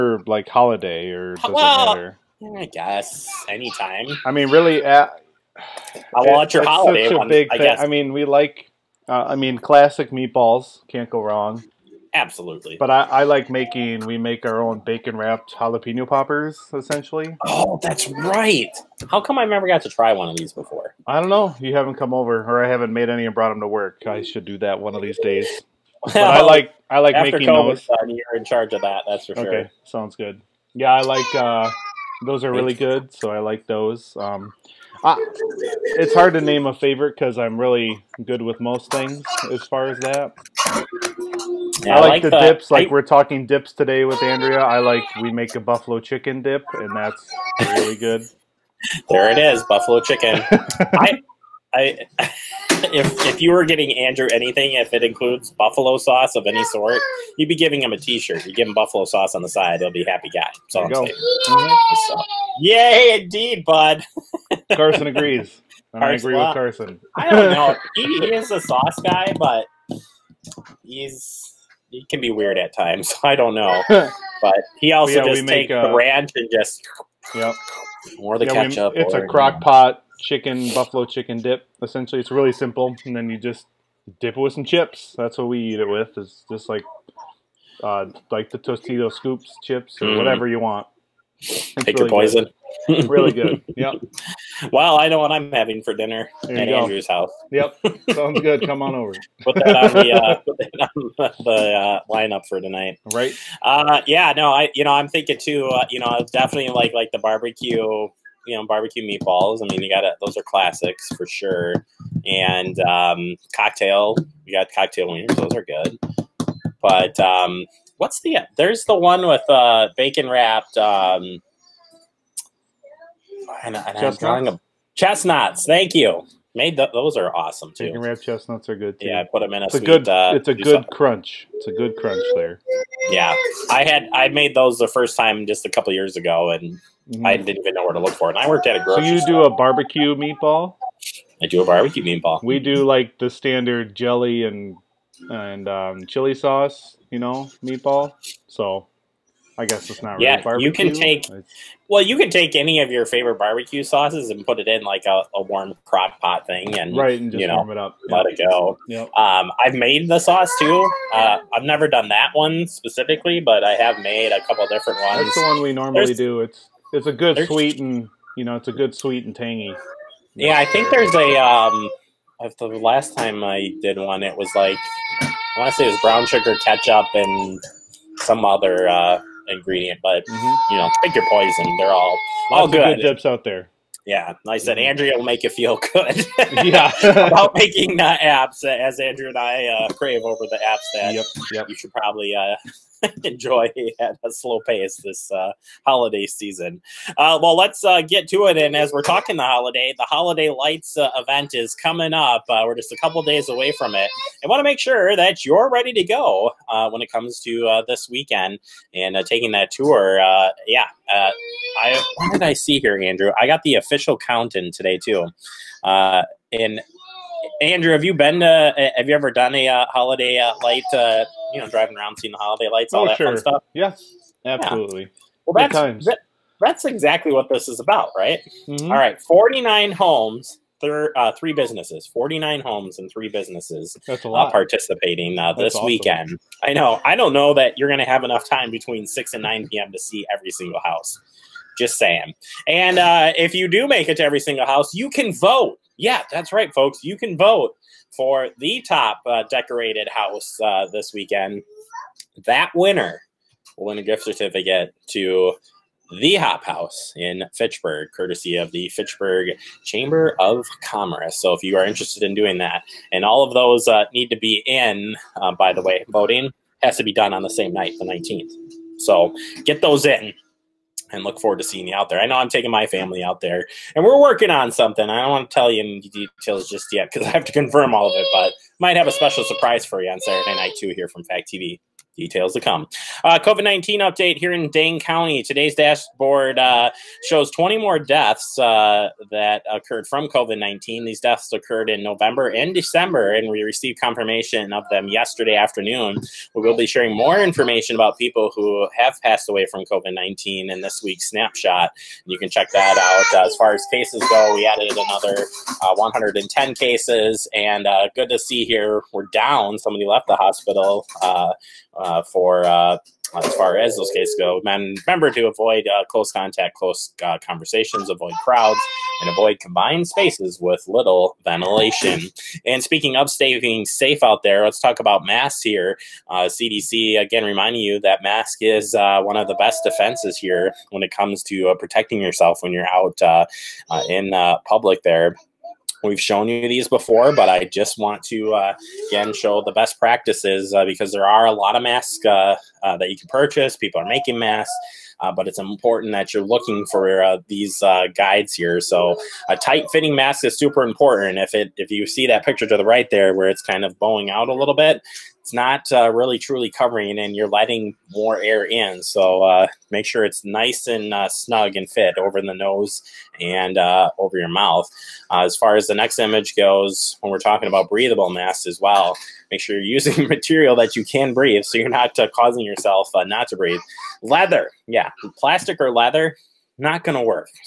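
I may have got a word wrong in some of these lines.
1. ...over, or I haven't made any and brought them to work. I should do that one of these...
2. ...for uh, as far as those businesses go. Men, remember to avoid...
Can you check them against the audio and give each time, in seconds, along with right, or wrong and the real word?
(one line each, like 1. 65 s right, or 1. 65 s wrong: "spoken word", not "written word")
1. 22 s right
2. 312 s wrong: "cases", not "businesses".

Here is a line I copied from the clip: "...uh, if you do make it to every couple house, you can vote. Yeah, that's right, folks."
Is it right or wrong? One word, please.
wrong.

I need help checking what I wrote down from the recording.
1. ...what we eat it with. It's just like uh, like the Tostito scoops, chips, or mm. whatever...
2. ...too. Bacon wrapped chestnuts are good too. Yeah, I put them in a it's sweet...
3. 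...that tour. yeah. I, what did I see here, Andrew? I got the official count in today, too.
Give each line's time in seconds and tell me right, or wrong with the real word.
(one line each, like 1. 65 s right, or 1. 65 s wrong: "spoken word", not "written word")
1. 85 s right
2. 127 s right
3. 209 s right.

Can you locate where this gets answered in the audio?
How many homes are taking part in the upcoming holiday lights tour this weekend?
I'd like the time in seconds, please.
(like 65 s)
232 s.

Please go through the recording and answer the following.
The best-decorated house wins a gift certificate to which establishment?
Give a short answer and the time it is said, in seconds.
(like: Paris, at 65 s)
Hop House, at 256 s.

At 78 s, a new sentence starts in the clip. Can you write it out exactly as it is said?
We, it's or, a crock pot chicken, buffalo chicken dip.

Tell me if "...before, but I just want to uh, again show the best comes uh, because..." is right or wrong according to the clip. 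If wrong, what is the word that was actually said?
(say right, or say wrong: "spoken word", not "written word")
wrong: "practices", not "comes".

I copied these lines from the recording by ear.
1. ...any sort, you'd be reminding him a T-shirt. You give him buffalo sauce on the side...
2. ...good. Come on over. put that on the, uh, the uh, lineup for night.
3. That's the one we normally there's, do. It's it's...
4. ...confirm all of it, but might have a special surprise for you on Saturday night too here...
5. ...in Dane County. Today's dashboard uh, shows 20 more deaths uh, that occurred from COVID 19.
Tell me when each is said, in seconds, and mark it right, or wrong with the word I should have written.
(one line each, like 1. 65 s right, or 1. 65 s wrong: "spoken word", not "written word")
1. 56 s wrong: "giving", not "reminding"
2. 98 s wrong: "tonight", not "night"
3. 165 s right
4. 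277 s right
5. 284 s right.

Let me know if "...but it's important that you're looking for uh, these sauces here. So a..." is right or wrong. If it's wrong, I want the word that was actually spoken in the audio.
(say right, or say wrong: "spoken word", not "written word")
wrong: "guides", not "sauces".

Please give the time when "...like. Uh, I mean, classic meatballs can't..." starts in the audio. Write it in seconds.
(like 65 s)
8 s.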